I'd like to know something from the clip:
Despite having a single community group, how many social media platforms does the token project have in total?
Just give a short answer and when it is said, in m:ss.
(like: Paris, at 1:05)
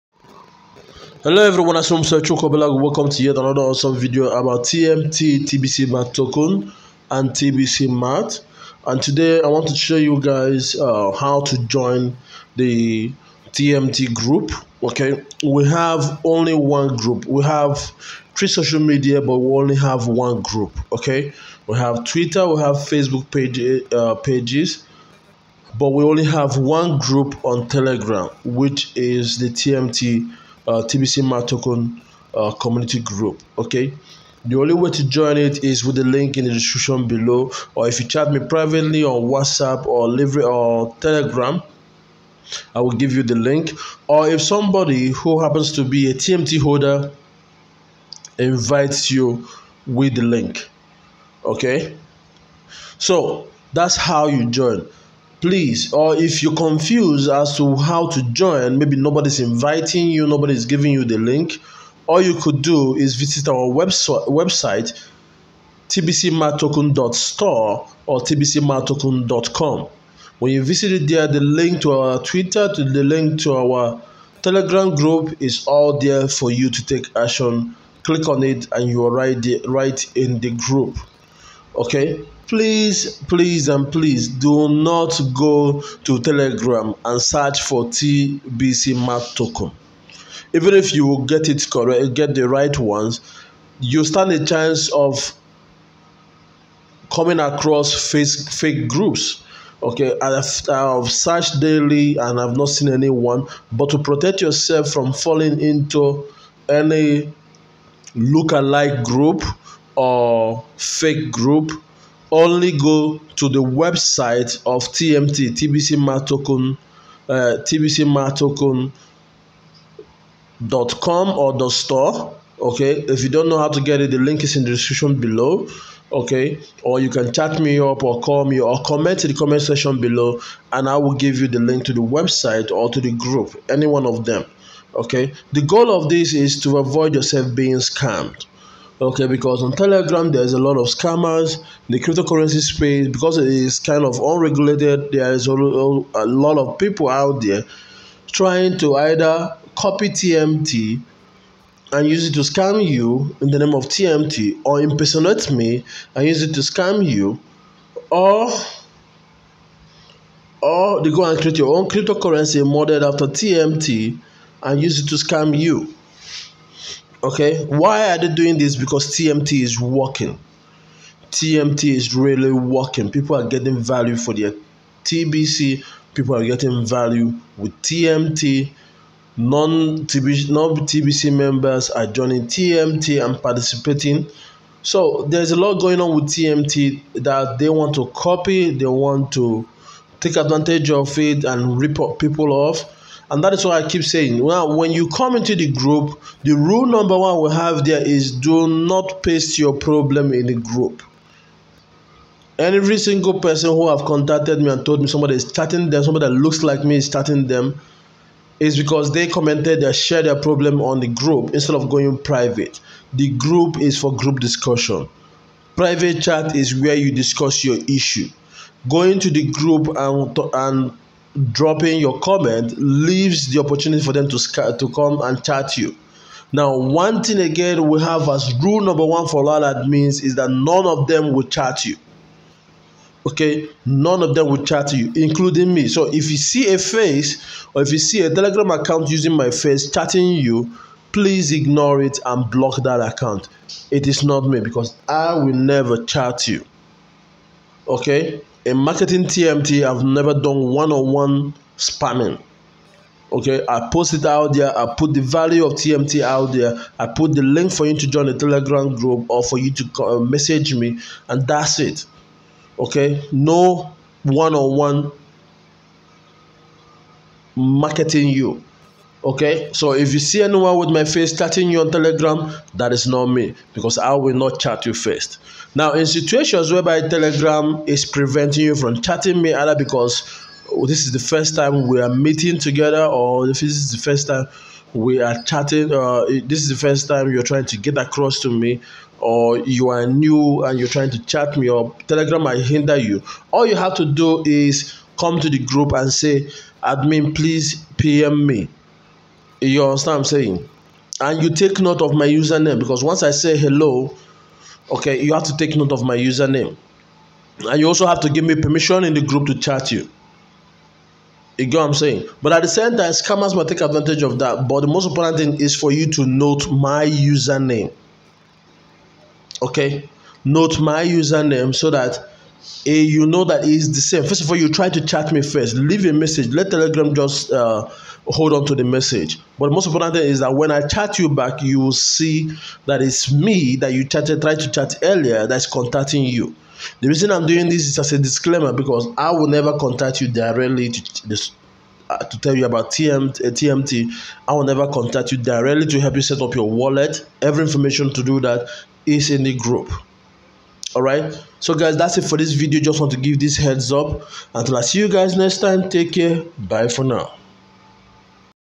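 3, at 0:18.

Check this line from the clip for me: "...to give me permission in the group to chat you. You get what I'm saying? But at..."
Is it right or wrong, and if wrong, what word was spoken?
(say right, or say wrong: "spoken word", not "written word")
right.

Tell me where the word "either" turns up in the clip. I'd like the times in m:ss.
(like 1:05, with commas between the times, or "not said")
2:28, 4:39.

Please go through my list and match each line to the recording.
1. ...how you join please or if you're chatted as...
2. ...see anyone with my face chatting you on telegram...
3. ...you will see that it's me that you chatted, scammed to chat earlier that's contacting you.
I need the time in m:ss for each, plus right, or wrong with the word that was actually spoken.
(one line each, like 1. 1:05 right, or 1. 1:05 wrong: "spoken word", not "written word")
1. 0:53 wrong: "confused", not "chatted"
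2. 4:30 right
3. 5:31 wrong: "tried", not "scammed".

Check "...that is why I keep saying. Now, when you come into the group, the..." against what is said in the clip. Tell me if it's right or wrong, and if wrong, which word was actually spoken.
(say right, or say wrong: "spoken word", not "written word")
right.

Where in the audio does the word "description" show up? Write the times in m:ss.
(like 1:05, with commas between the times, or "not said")
0:36, 2:04.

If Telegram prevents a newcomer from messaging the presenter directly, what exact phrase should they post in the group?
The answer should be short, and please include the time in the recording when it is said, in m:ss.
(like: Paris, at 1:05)
admin please pm me, at 4:56.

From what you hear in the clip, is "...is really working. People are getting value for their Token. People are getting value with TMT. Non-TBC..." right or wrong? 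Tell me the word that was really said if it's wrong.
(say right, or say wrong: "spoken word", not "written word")
wrong: "TBC", not "Token".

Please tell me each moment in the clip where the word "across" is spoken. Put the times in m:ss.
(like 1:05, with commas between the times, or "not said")
1:37, 4:47.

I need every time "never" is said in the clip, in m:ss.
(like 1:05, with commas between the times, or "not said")
4:05, 4:10, 5:39, 5:44.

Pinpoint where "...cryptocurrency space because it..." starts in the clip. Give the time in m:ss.
2:21.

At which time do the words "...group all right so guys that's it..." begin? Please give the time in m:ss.
5:49.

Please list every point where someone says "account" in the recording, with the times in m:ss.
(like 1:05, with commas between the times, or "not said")
3:58, 4:02.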